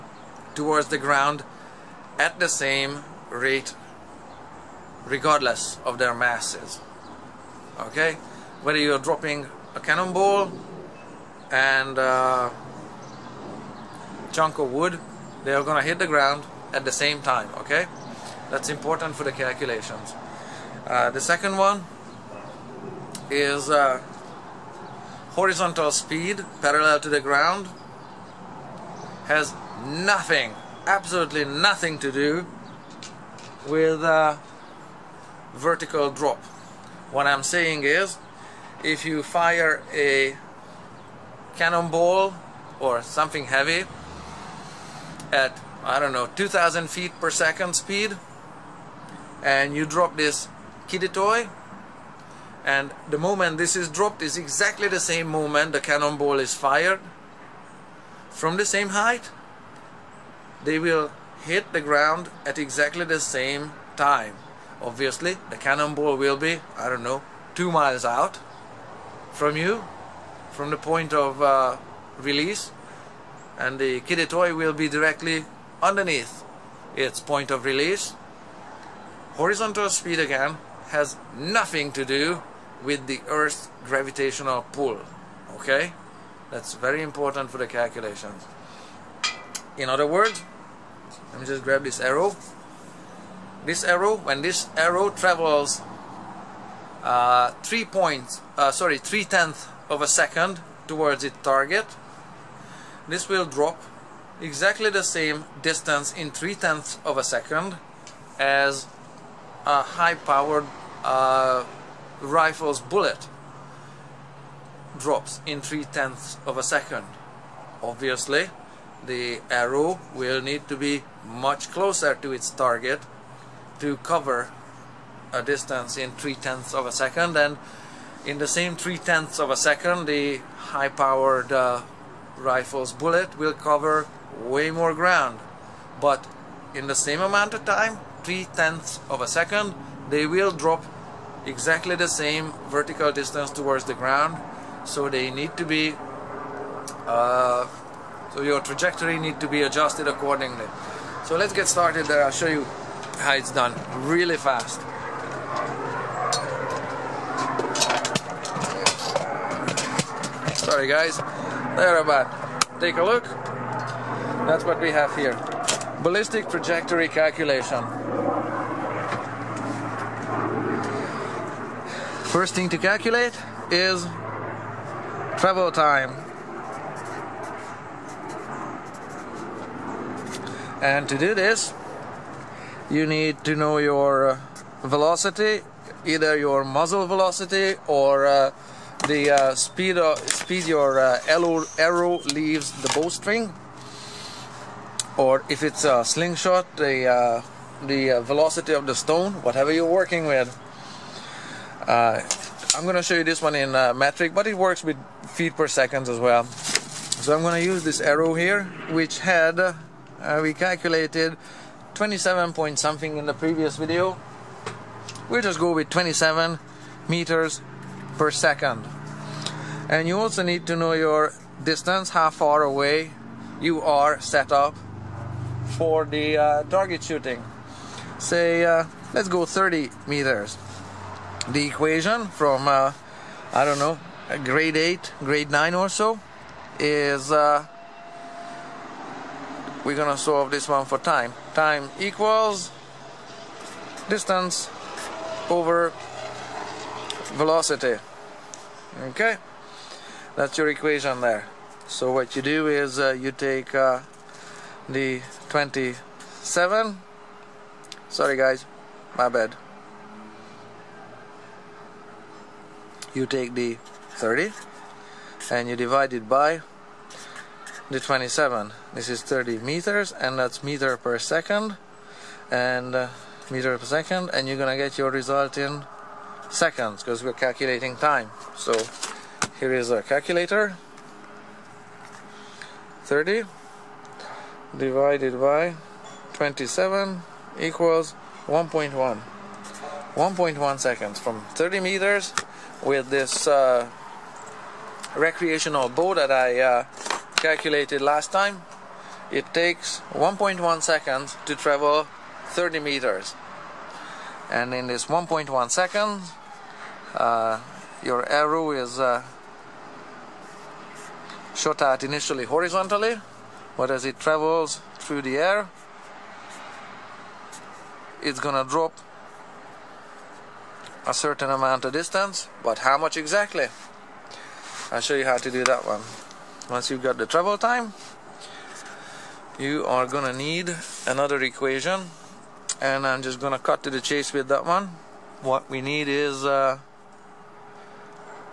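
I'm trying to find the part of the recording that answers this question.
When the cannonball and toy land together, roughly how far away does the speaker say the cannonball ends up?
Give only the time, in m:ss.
1:07.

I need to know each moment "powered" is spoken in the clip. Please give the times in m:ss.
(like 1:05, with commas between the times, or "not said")
1:50, 2:10.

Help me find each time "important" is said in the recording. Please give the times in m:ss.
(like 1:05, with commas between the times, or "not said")
0:18, 1:27.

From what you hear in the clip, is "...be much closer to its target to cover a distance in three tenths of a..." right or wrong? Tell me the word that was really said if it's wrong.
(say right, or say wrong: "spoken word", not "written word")
right.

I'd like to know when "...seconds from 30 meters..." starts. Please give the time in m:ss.
4:50.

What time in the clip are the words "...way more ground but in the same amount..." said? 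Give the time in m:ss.
2:14.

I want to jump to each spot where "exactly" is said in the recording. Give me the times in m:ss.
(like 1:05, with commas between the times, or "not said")
0:54, 1:02, 1:44, 2:21, 5:23.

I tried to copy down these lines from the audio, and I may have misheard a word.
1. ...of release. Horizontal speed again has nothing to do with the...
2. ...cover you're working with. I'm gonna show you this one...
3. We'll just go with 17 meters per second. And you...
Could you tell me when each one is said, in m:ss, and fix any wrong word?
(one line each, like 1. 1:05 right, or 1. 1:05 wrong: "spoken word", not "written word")
1. 1:17 right
2. 3:19 wrong: "whatever", not "cover"
3. 3:35 wrong: "27", not "17".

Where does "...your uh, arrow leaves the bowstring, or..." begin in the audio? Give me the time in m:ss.
3:10.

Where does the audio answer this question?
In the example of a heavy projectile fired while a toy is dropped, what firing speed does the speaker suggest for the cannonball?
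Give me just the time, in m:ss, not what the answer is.
0:46.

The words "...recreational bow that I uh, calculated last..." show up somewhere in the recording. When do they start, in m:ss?
4:55.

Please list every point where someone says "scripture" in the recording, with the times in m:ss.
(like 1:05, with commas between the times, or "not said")
not said.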